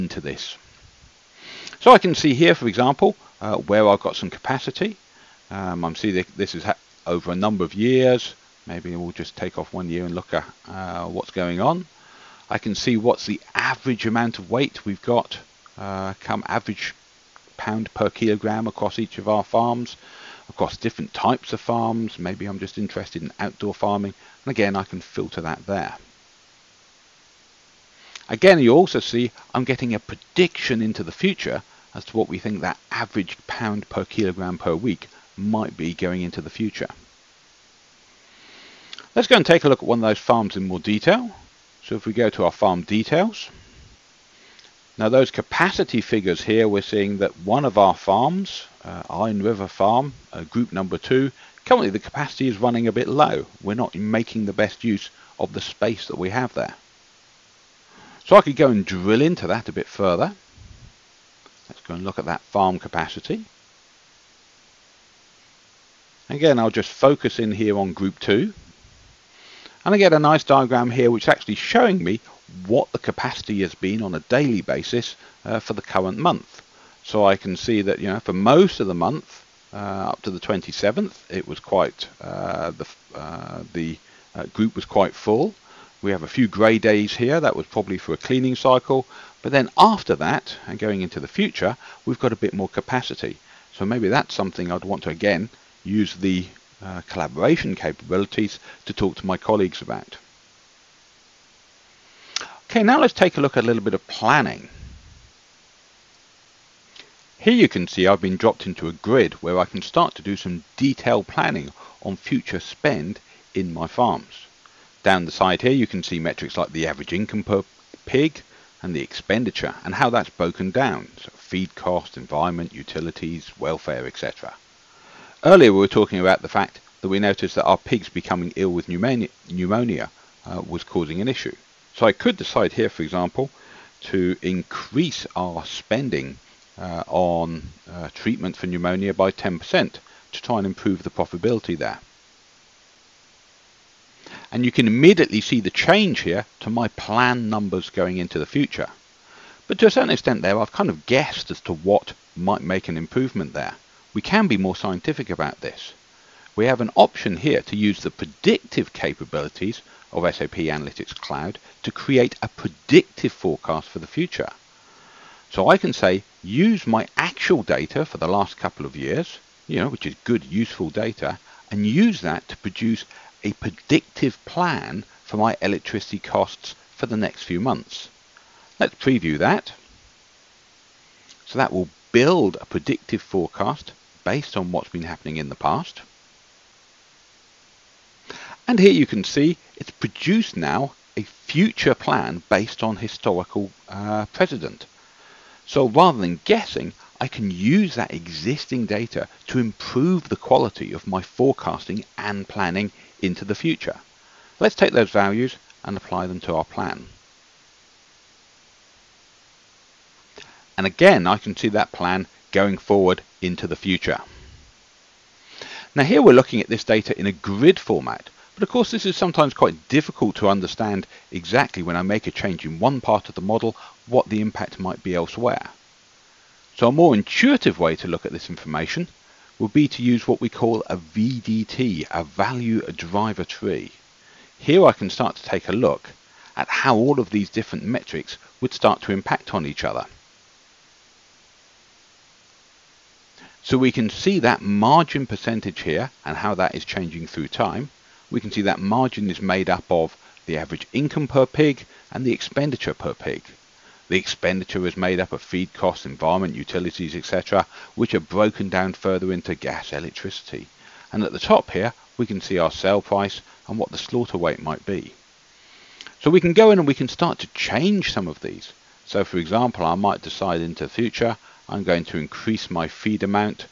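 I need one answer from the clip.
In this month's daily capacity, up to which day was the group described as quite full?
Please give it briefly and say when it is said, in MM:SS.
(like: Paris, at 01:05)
27th, at 01:20.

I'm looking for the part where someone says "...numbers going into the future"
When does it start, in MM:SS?
02:27.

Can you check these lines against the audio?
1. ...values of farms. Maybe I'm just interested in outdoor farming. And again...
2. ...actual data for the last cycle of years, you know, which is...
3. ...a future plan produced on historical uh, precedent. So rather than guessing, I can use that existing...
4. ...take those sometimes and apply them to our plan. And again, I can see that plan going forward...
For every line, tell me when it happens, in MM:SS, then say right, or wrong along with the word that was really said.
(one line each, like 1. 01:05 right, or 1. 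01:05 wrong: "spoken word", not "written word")
1. 00:21 wrong: "types", not "values"
2. 02:47 wrong: "couple", not "cycle"
3. 03:11 wrong: "based", not "produced"
4. 03:24 wrong: "values", not "sometimes".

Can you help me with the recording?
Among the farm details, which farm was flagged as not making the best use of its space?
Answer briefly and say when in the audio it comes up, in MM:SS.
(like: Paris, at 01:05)
Iron River Farm, at 00:49.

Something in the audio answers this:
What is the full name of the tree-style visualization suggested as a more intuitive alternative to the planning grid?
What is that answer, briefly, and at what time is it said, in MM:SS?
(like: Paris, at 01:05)
value driver tree, at 03:52.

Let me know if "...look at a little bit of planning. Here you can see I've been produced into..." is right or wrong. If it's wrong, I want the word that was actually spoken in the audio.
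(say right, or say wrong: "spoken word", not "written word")
wrong: "dropped", not "produced".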